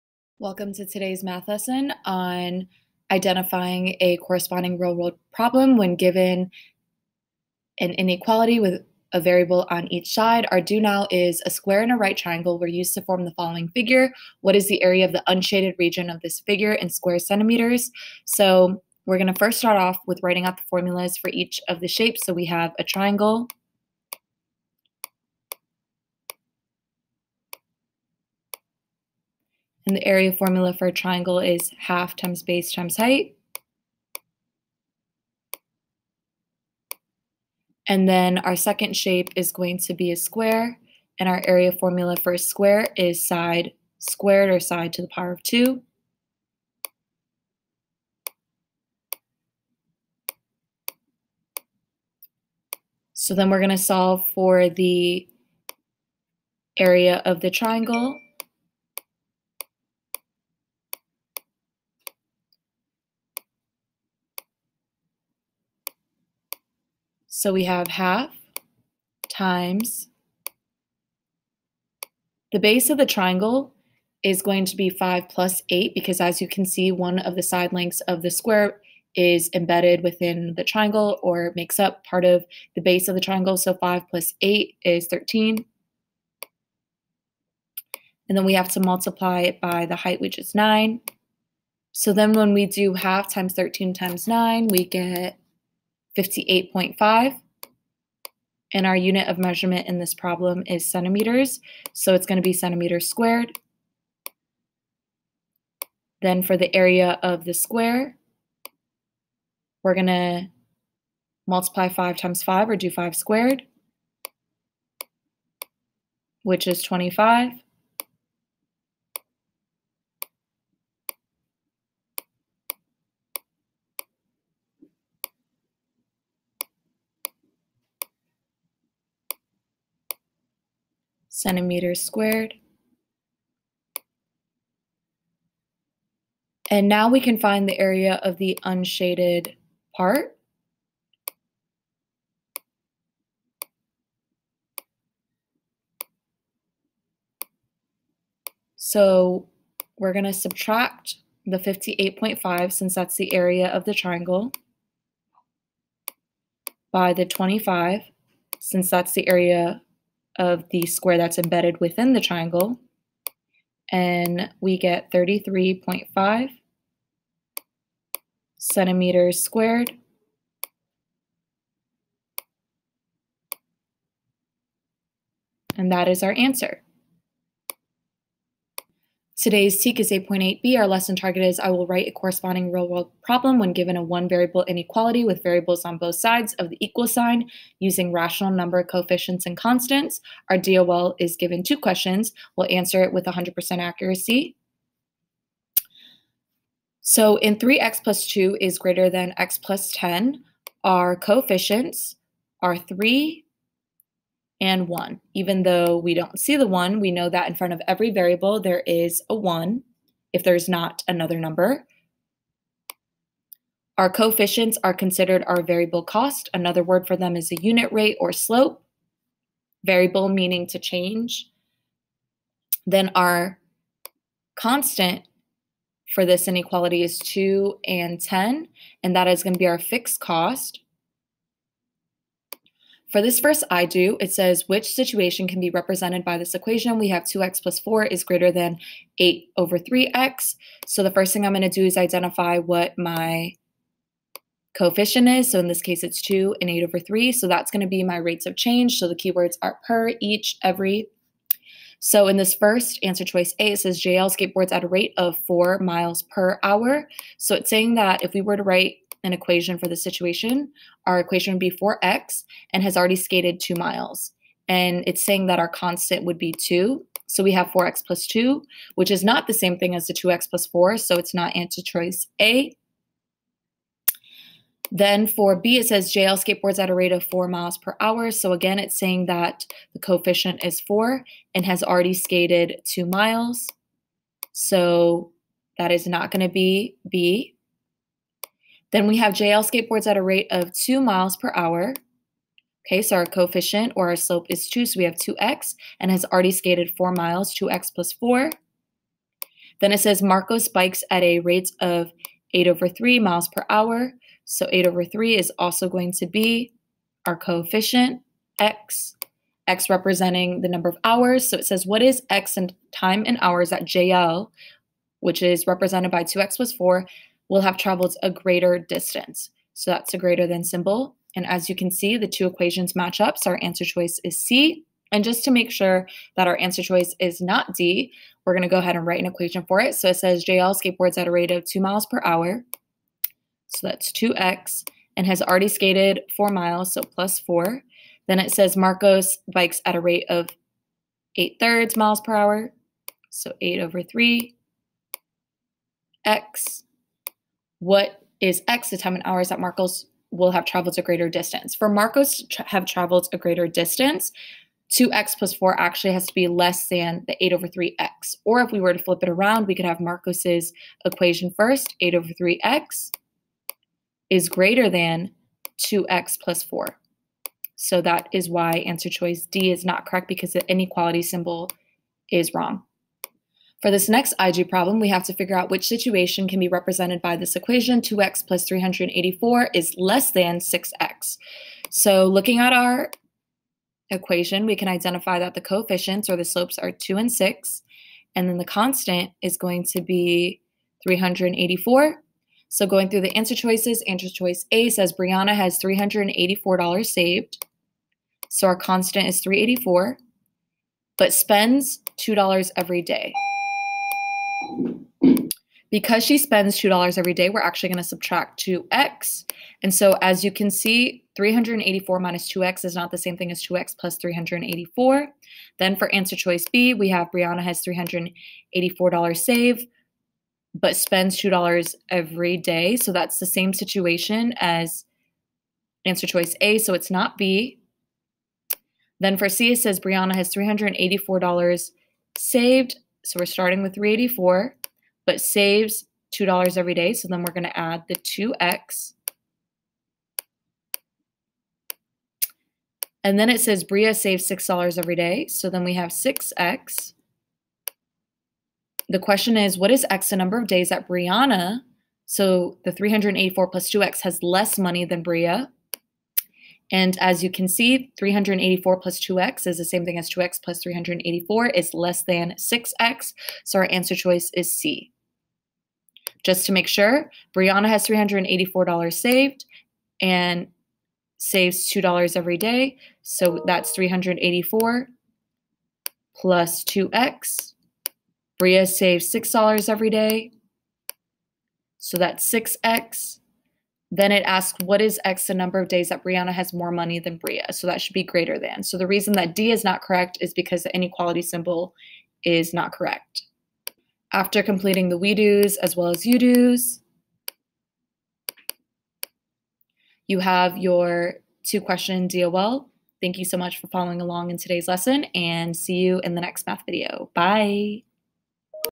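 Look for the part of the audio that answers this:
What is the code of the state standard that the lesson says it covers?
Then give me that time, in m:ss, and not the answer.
3:00.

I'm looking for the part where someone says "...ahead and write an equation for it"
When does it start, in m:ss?
5:28.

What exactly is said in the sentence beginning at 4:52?
Okay, so our coefficient or our slope is 2, so we have 2x and has already skated 4 miles, 2x plus 4.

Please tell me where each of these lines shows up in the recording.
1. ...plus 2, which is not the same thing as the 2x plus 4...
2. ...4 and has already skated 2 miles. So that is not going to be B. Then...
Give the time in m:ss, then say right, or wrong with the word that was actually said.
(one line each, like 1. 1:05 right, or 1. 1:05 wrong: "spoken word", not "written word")
1. 4:28 right
2. 4:40 right.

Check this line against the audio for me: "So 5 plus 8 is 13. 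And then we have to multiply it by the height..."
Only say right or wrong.
right.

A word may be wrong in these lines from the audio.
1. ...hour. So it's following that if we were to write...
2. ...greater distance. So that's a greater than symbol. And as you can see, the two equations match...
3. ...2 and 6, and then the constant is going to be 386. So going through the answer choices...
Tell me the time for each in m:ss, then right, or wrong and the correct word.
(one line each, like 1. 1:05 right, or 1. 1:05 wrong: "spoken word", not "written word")
1. 4:16 wrong: "saying", not "following"
2. 5:18 right
3. 6:26 wrong: "384", not "386".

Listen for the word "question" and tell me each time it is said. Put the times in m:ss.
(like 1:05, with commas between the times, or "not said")
3:11, 7:29, 8:21.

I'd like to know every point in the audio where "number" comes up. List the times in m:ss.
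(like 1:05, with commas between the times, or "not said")
3:08, 3:31, 5:10, 7:30, 8:05.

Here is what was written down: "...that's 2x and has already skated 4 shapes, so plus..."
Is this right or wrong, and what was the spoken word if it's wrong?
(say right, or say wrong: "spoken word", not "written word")
wrong: "miles", not "shapes".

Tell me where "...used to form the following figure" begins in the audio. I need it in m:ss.
0:12.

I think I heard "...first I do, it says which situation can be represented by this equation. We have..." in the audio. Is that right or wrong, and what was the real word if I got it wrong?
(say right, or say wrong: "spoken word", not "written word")
right.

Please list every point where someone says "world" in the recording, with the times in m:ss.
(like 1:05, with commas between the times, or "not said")
0:04, 3:02.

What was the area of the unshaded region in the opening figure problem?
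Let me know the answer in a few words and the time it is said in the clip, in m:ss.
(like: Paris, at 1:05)
33.5 square centimeters, at 2:45.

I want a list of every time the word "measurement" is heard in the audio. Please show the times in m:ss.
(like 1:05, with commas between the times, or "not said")
1:39.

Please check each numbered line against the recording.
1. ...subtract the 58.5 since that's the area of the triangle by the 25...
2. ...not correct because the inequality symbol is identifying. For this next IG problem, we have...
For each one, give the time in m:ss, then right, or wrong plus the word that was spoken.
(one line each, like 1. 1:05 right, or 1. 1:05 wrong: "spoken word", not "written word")
1. 2:30 right
2. 6:09 wrong: "wrong", not "identifying".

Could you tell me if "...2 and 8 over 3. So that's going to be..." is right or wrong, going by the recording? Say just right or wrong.
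right.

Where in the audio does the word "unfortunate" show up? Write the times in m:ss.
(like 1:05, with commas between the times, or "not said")
not said.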